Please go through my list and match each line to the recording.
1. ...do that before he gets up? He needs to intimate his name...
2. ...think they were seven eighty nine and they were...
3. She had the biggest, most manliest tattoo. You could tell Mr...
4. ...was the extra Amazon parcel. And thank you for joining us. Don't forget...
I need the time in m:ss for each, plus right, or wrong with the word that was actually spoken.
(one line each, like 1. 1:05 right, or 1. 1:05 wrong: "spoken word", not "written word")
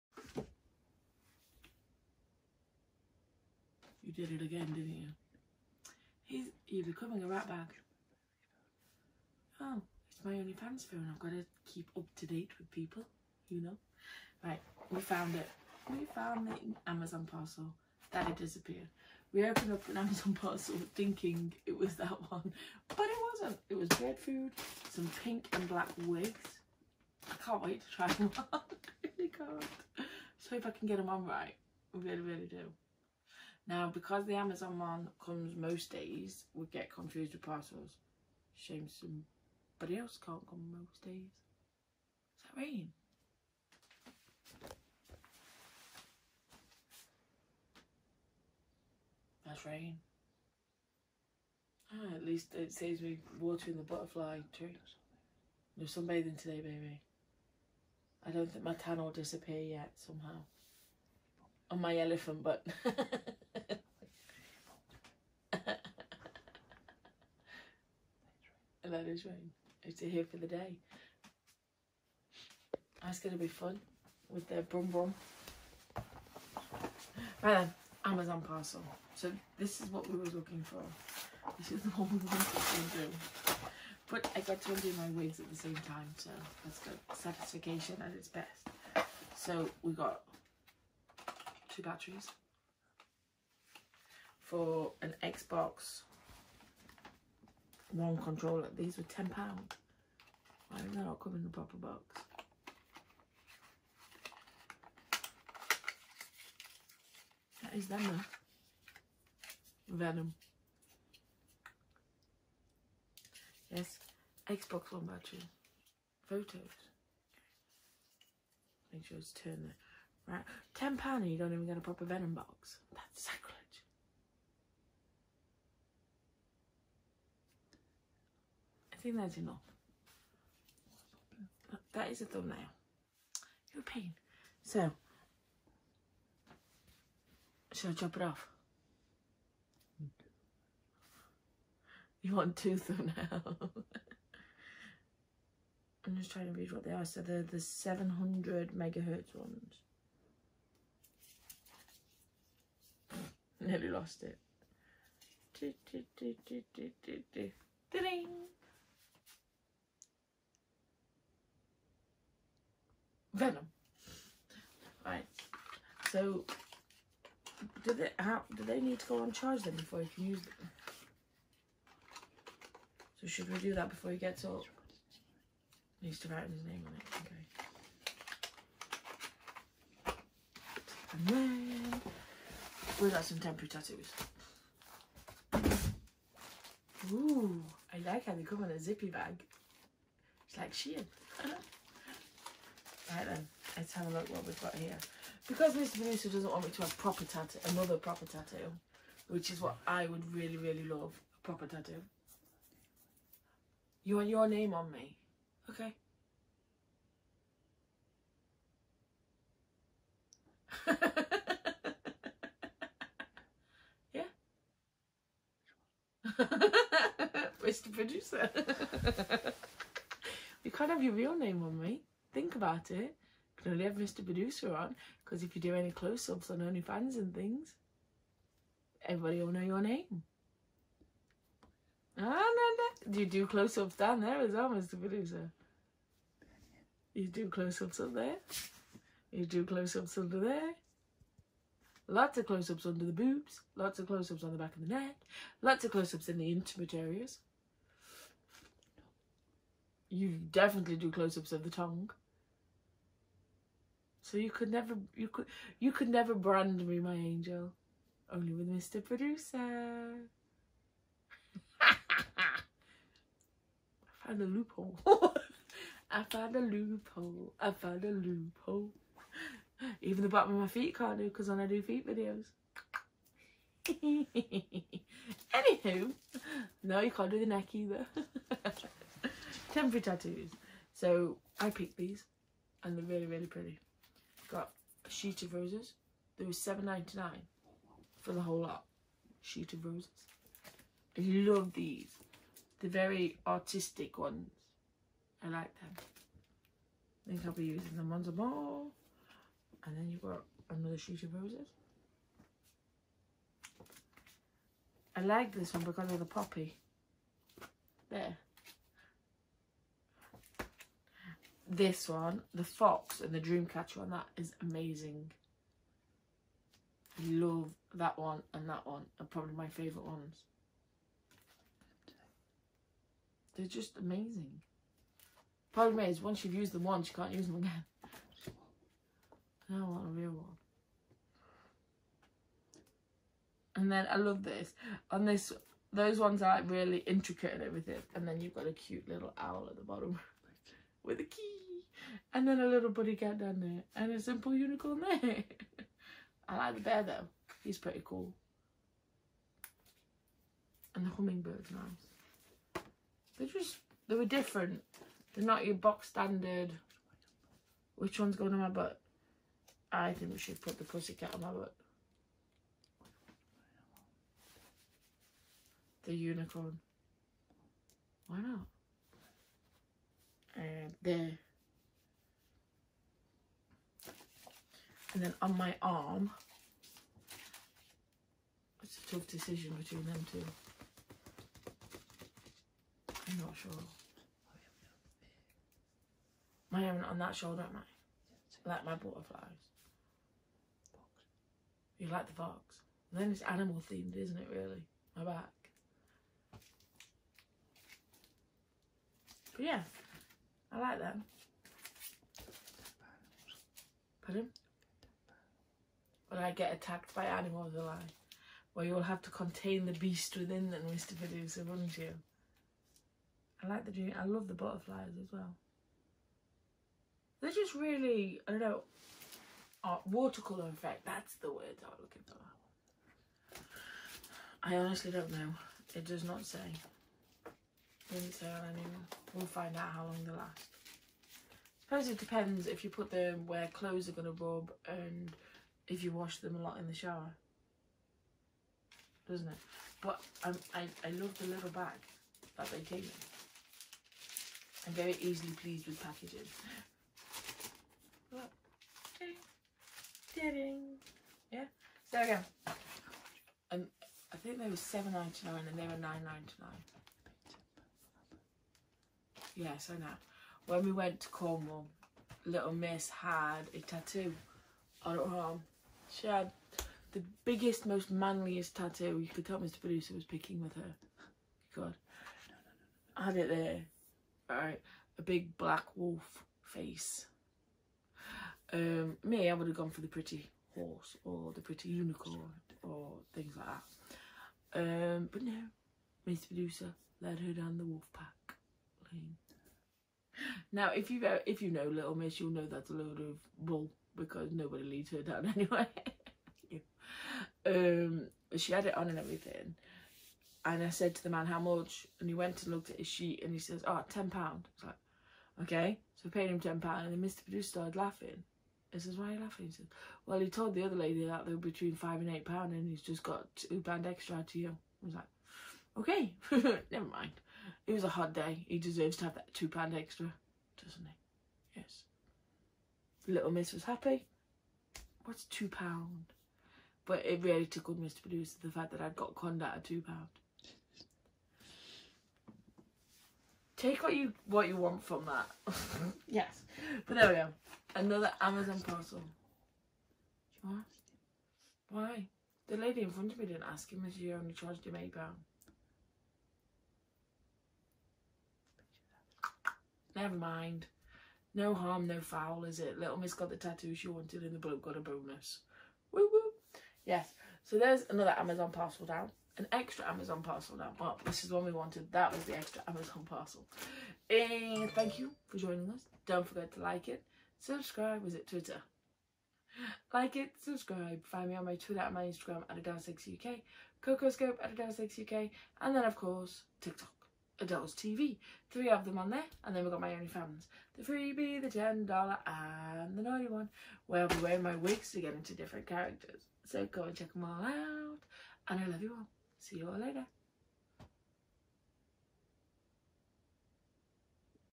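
1. 2:53 wrong: "write", not "intimate"
2. 7:34 wrong: "ninety", not "eighty"
3. 7:46 right
4. 9:22 right.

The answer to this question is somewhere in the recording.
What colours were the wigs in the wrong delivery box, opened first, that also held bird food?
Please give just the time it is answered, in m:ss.
0:25.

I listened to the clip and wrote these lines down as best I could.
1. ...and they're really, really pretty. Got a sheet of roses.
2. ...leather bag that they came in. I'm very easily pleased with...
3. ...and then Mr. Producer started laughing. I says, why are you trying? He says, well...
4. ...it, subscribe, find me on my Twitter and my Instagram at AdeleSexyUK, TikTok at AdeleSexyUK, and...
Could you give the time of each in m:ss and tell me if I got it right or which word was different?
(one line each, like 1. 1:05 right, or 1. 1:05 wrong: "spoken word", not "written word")
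1. 4:42 right
2. 7:21 right
3. 8:26 wrong: "laughing", not "trying"
4. 9:30 wrong: "CocoScope", not "TikTok".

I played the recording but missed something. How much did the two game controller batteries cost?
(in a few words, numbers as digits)
£10.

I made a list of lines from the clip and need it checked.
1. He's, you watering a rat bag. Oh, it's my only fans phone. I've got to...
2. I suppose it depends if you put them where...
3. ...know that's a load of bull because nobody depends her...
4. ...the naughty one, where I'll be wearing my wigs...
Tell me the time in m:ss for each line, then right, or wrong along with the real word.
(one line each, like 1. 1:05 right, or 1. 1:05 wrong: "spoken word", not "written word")
1. 0:06 wrong: "becoming", not "watering"
2. 7:11 right
3. 8:12 wrong: "leads", not "depends"
4. 9:43 right.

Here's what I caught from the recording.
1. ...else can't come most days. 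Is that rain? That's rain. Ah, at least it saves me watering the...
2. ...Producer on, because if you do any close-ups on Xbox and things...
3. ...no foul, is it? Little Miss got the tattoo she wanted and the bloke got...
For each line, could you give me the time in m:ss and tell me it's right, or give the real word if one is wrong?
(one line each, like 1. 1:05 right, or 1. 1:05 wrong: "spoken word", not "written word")
1. 0:39 right
2. 3:44 wrong: "OnlyFans", not "Xbox"
3. 9:12 right.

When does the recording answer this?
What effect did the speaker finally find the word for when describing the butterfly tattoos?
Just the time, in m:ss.
7:00.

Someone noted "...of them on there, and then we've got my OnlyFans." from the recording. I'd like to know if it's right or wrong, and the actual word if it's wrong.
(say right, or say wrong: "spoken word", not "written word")
right.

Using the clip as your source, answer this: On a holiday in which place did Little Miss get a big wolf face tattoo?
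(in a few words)
Cornwall.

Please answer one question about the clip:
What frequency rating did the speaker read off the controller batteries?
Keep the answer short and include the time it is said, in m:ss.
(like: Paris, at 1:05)
700 megahertz, at 2:27.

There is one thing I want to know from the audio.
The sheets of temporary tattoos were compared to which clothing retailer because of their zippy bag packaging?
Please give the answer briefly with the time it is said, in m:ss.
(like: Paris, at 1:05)
Shein, at 3:10.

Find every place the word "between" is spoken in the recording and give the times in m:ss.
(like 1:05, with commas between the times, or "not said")
6:19, 8:31.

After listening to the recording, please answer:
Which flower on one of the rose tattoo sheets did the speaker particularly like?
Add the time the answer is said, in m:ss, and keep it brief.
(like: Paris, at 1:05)
poppy, at 5:06.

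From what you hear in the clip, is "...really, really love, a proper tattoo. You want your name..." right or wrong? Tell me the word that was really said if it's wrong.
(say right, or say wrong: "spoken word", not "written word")
right.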